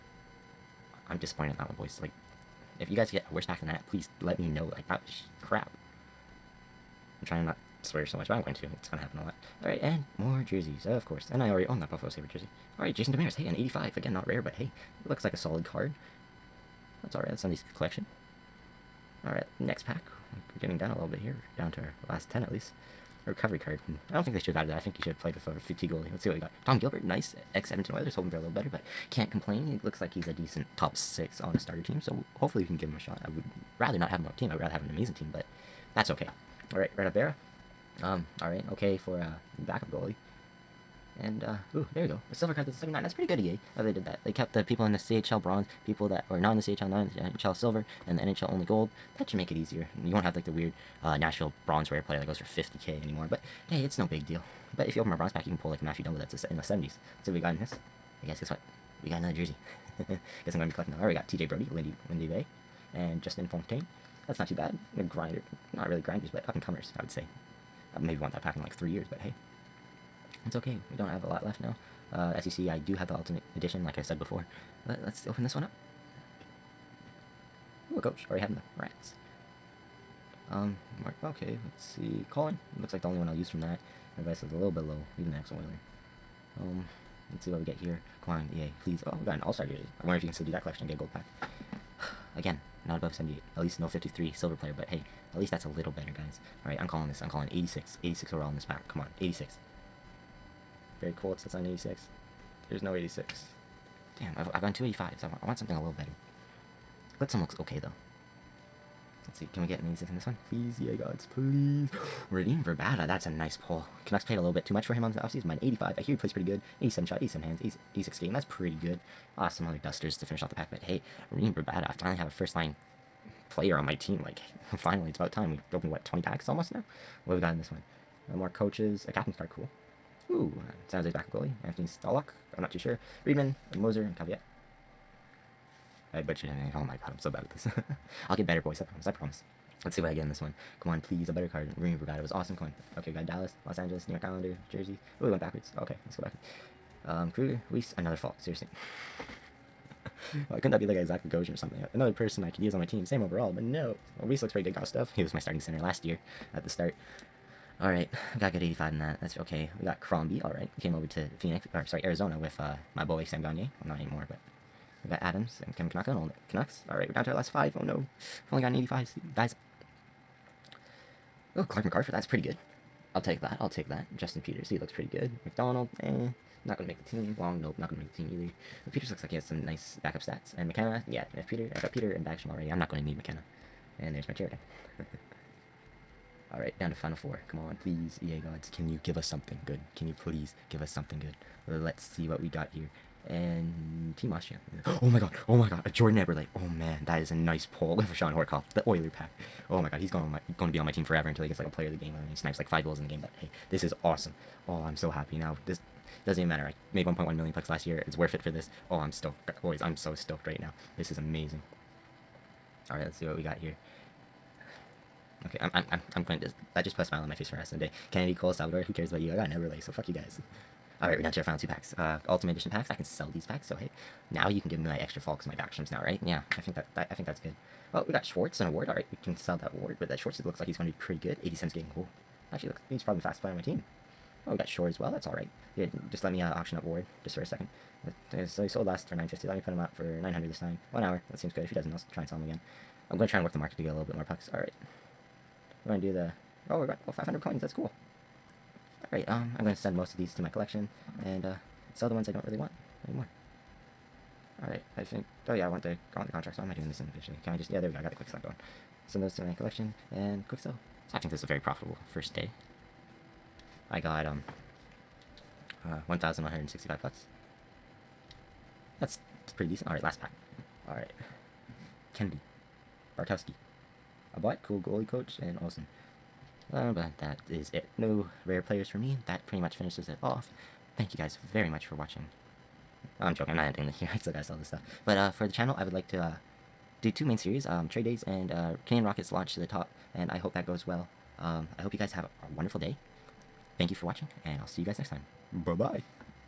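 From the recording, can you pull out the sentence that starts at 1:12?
Uh, as you see, I do have the Ultimate Edition, like I said before.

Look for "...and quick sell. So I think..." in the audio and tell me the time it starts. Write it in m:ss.
4:20.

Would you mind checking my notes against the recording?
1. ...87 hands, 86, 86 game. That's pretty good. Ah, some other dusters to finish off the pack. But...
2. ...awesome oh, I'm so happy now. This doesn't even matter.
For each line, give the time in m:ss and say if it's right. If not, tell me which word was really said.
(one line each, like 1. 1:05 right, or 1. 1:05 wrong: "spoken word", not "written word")
1. 1:57 right
2. 3:24 right.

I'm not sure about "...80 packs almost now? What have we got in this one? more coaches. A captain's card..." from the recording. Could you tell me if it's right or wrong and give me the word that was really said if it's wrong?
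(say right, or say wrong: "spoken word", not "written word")
wrong: "20", not "80".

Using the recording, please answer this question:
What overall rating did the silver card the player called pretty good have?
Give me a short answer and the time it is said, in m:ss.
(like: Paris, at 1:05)
79, at 0:42.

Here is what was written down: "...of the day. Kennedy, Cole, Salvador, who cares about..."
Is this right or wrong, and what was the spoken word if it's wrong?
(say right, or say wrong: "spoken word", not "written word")
right.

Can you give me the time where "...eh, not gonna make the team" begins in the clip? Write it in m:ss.
2:56.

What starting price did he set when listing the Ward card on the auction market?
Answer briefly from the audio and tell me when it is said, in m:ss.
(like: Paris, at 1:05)
900, at 4:00.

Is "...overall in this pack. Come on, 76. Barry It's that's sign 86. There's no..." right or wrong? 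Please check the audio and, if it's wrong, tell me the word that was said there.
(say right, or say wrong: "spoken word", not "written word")
wrong: "86", not "76".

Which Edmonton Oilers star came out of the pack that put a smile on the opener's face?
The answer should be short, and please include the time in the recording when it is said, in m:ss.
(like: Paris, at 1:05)
Jordan Eberle, at 3:15.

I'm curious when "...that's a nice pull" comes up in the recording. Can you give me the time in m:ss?
1:53.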